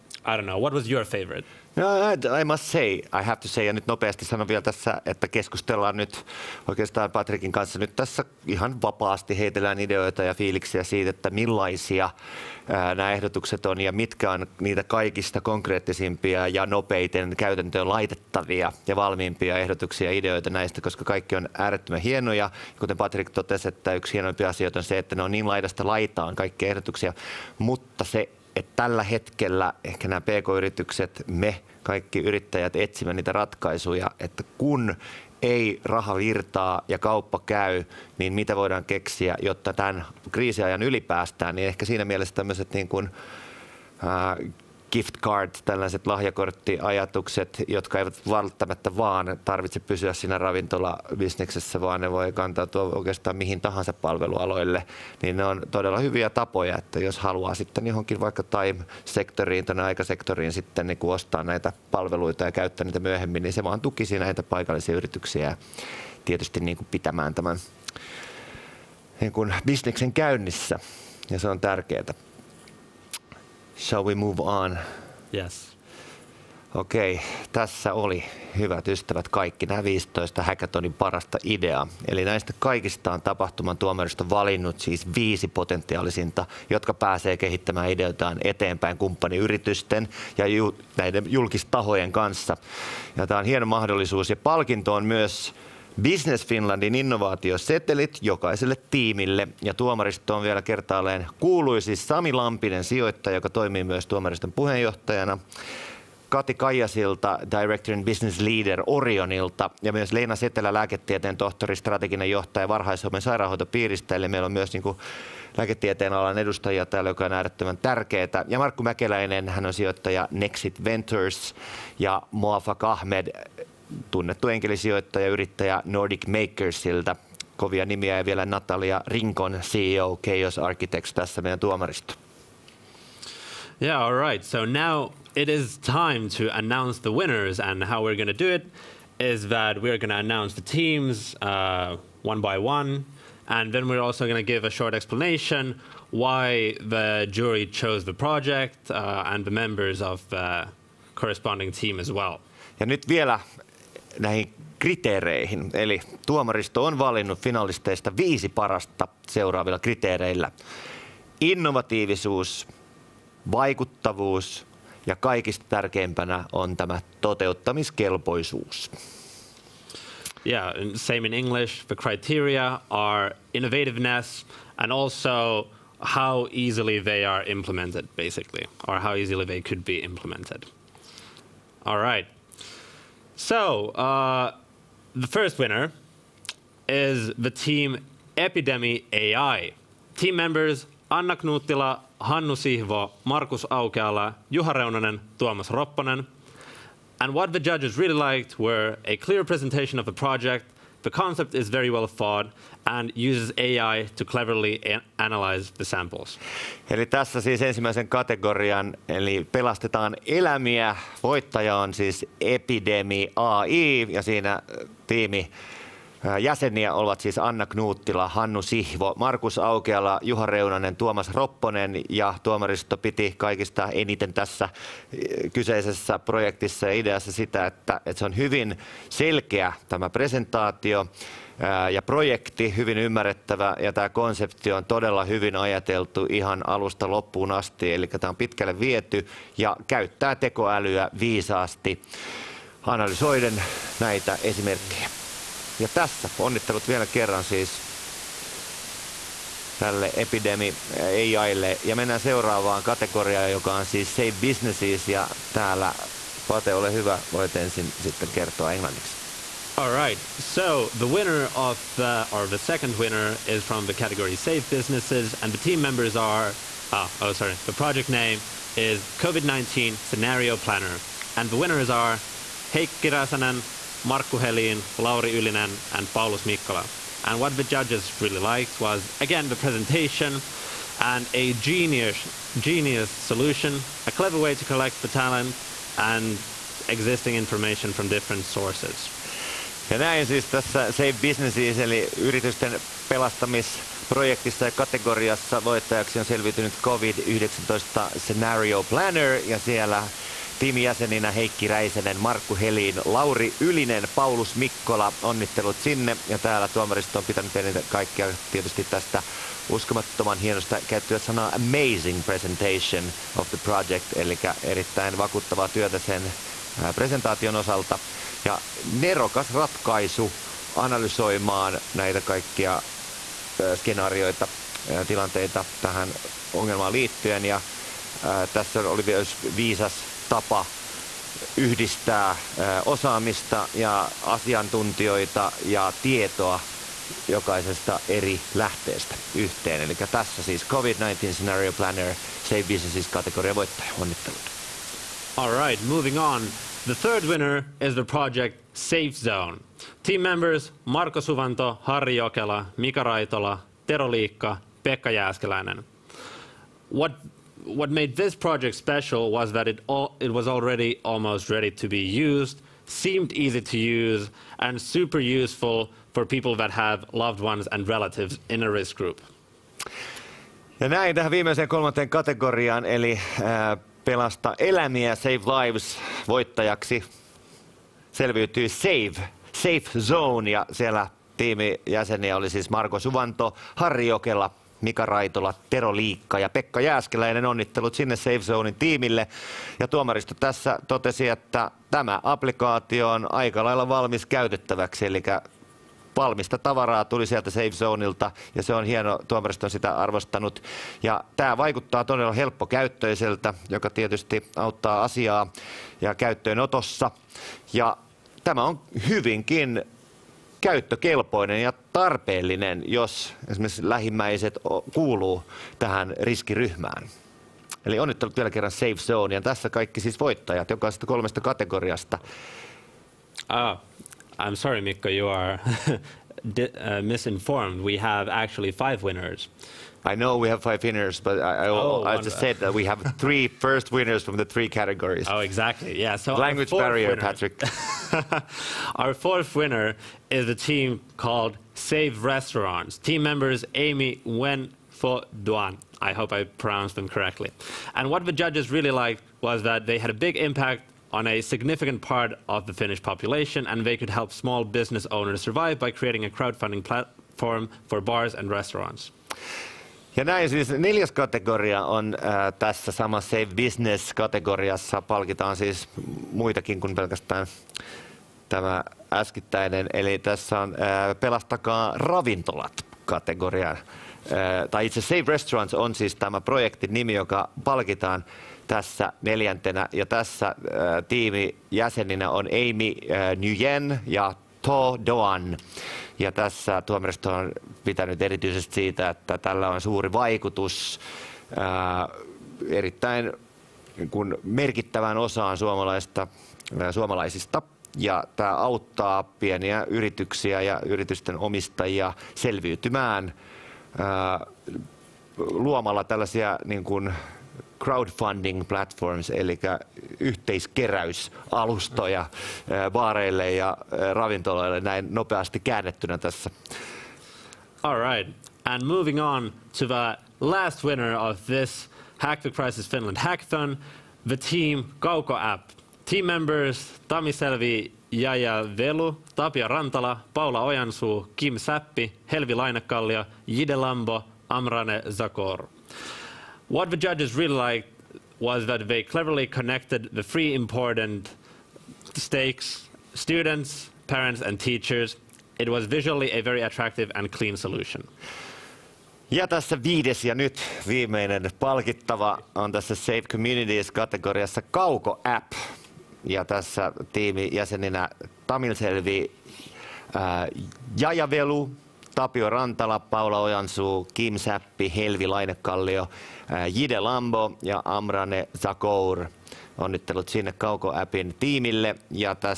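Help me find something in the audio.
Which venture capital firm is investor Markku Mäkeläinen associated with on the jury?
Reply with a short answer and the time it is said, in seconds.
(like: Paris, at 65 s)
Nexit Ventures, at 120 s.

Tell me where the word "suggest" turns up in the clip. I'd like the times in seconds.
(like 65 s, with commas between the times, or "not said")
not said.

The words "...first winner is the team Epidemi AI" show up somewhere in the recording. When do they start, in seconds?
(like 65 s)
185 s.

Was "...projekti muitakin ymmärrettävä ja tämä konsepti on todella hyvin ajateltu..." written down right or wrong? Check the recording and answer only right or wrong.
wrong.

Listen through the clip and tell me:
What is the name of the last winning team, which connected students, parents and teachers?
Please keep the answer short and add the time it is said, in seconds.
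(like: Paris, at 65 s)
Kauko App, at 524 s.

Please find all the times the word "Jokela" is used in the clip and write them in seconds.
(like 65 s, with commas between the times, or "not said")
352 s, 384 s.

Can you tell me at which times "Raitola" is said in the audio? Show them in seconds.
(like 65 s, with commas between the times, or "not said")
353 s, 385 s.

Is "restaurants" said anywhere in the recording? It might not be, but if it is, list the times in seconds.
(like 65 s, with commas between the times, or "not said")
442 s, 458 s, 475 s.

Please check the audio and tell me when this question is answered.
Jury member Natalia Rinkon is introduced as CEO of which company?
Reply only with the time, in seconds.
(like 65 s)
130 s.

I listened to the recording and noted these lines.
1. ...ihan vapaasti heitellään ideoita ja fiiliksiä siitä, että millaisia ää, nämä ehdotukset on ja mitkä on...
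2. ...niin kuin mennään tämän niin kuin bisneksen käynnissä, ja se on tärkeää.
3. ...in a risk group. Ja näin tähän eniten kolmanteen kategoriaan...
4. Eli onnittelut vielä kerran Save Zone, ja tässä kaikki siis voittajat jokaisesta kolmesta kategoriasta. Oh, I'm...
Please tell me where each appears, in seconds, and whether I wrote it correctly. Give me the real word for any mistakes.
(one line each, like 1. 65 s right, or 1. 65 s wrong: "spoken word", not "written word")
1. 8 s right
2. 66 s wrong: "pitämään", not "mennään"
3. 368 s wrong: "viimeiseen", not "eniten"
4. 417 s wrong: "Safe", not "Save".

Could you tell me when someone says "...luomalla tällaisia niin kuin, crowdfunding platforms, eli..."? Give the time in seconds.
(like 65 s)
505 s.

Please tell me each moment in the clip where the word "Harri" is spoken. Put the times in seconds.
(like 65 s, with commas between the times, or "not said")
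351 s, 383 s.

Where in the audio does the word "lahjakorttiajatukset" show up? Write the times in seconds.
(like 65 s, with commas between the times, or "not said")
46 s.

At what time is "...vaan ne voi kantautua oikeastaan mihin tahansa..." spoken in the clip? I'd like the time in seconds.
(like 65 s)
51 s.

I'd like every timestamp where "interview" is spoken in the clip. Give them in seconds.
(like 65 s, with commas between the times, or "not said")
not said.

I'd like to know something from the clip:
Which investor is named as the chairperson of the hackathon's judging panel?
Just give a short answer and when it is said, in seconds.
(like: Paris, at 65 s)
Sami Lampinen, at 101 s.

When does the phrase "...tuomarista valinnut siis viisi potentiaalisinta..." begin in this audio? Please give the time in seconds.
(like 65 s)
83 s.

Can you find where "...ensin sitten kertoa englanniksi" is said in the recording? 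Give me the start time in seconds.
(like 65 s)
257 s.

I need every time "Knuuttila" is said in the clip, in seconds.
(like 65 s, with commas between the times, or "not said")
191 s, 217 s.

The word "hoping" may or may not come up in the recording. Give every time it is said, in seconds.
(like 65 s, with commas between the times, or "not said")
not said.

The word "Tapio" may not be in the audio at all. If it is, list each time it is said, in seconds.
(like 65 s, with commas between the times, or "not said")
529 s, 562 s.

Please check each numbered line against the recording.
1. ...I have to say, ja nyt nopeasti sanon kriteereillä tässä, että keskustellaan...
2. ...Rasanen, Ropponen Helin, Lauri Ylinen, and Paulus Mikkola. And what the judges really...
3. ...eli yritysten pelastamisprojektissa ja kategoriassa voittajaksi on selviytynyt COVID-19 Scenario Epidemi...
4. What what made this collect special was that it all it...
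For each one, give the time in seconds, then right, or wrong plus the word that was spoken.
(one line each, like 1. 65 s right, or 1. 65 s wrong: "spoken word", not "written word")
1. 3 s wrong: "vielä", not "kriteereillä"
2. 273 s wrong: "Markku", not "Ropponen"
3. 291 s wrong: "Planner", not "Epidemi"
4. 356 s wrong: "project", not "collect".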